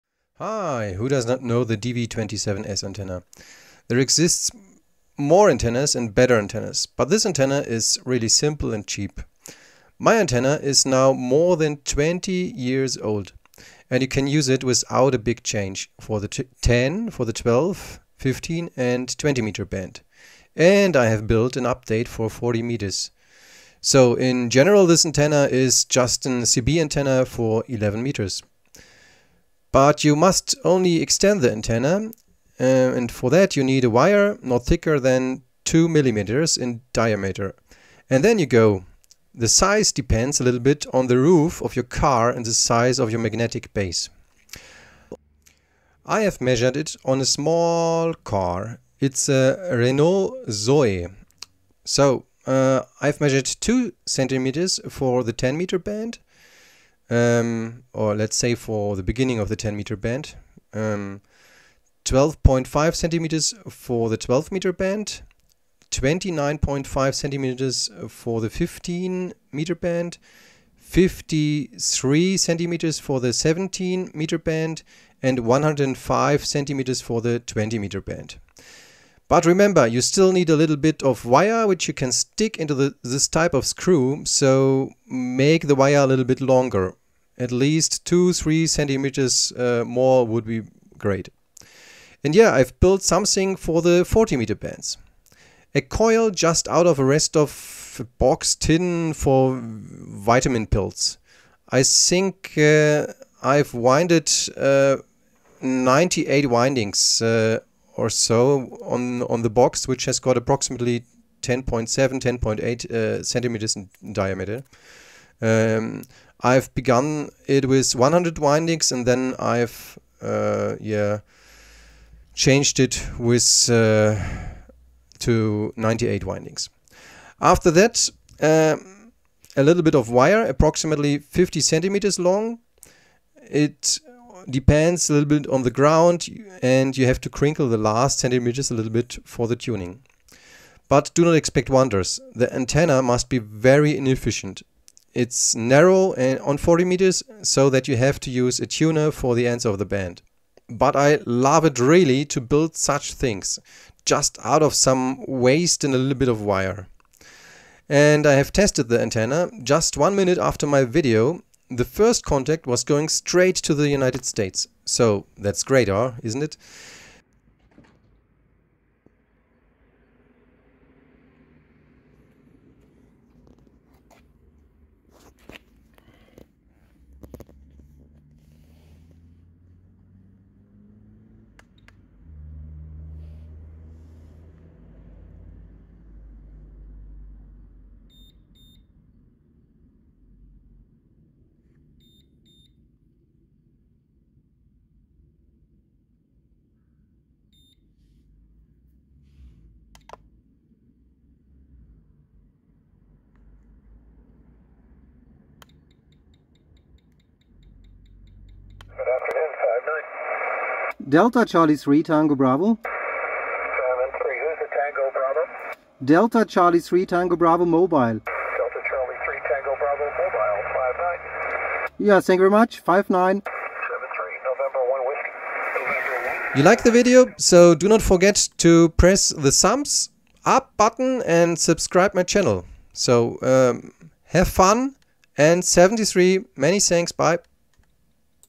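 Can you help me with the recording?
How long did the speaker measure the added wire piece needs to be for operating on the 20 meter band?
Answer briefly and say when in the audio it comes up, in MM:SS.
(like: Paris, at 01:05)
105 centimeters, at 01:15.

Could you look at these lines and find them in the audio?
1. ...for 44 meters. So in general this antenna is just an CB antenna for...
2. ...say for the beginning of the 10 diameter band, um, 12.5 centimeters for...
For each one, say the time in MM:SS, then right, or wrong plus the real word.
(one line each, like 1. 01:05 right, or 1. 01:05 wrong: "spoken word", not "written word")
1. 00:22 wrong: "40", not "44"
2. 00:58 wrong: "meter", not "diameter".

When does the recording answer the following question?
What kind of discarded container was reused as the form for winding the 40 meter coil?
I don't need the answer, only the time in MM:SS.
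01:38.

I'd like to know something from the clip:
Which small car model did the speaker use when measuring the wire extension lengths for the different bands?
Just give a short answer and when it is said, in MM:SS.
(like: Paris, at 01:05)
Renault Zoe, at 00:49.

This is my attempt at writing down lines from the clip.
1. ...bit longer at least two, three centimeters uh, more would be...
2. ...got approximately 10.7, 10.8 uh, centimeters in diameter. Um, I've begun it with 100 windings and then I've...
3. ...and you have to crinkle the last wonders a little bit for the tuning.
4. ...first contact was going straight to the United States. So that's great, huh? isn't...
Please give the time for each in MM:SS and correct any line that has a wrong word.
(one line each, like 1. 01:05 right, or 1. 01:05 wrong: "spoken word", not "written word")
1. 01:26 right
2. 01:50 right
3. 02:16 wrong: "centimeters", not "wonders"
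4. 02:41 right.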